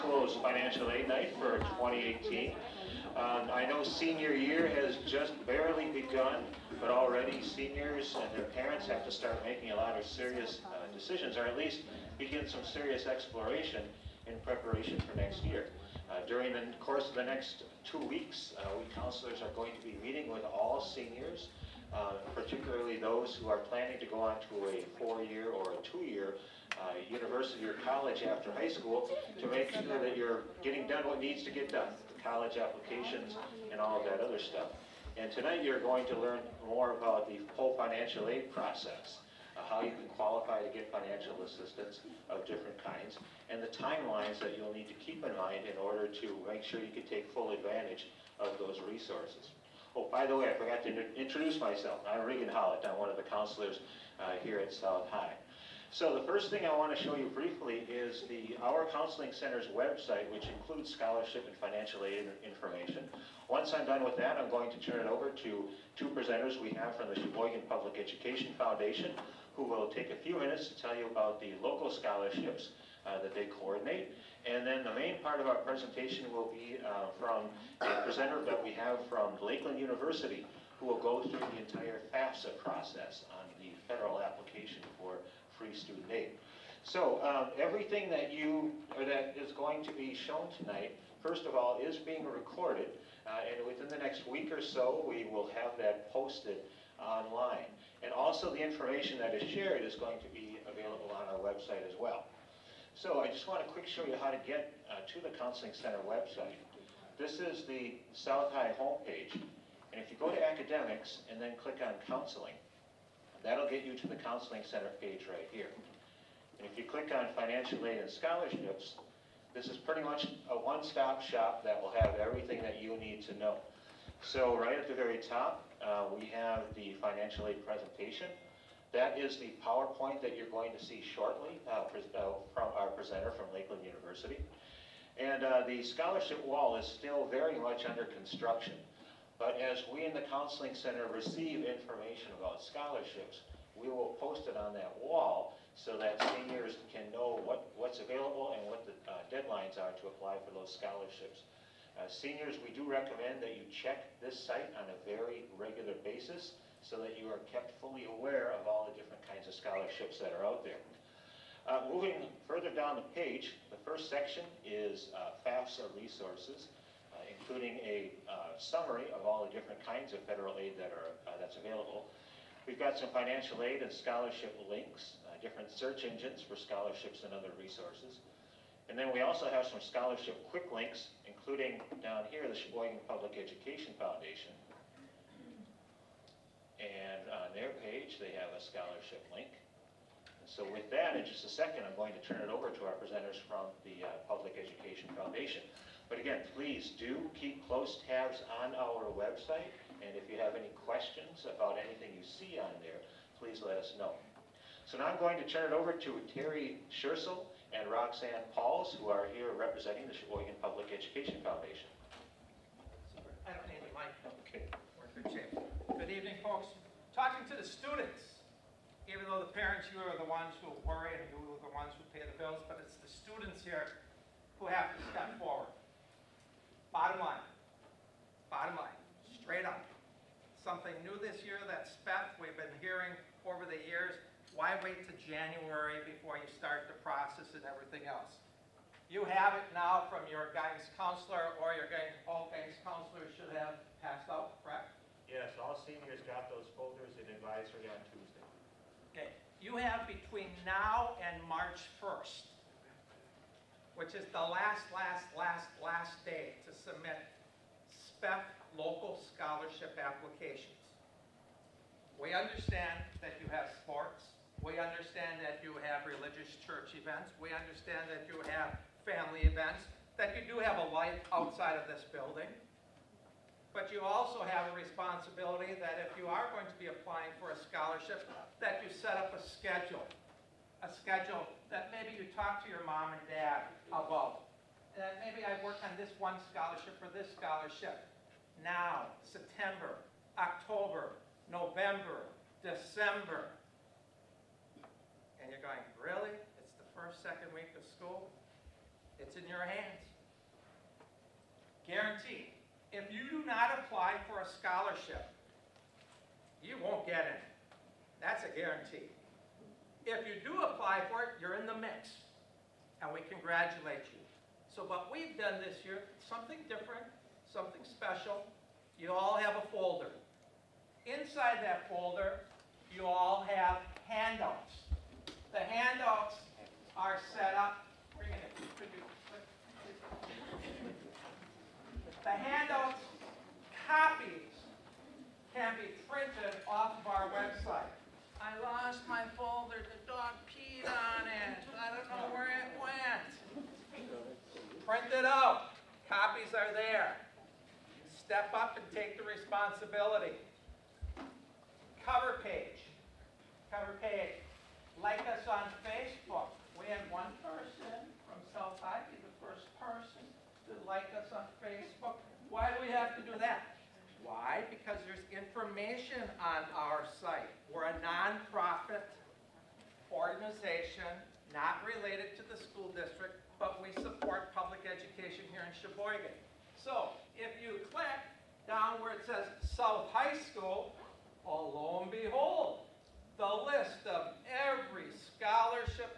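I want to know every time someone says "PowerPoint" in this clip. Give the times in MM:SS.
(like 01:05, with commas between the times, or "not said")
02:09.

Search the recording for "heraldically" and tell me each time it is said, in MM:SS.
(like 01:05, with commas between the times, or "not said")
not said.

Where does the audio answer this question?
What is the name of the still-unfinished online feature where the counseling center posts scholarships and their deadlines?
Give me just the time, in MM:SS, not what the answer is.
02:15.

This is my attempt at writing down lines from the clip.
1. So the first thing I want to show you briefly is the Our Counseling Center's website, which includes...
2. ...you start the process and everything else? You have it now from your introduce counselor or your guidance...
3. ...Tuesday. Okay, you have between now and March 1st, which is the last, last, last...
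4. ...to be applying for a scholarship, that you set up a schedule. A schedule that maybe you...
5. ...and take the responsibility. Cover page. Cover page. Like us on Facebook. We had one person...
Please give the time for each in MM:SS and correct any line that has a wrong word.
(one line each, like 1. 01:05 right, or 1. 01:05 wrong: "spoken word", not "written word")
1. 00:55 right
2. 03:56 wrong: "guidance", not "introduce"
3. 04:08 right
4. 04:36 right
5. 05:48 right.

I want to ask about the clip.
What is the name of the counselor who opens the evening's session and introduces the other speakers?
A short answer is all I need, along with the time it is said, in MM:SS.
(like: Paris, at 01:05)
Regan Hollett, at 00:52.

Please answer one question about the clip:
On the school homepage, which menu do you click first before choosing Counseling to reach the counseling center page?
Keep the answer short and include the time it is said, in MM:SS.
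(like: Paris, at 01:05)
Academics, at 01:50.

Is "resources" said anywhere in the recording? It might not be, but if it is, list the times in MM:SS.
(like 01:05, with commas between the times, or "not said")
00:48, 02:45, 02:57.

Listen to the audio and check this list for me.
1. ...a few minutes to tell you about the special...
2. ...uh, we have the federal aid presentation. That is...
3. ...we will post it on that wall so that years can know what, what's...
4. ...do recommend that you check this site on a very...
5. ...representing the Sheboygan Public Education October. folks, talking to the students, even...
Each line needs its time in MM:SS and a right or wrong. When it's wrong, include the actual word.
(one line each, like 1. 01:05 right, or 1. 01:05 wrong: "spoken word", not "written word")
1. 01:10 wrong: "local", not "special"
2. 02:05 wrong: "financial", not "federal"
3. 02:23 wrong: "seniors", not "years"
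4. 02:32 right
5. 03:29 wrong: "Foundation", not "October".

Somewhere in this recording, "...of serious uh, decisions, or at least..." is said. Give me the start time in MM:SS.
00:09.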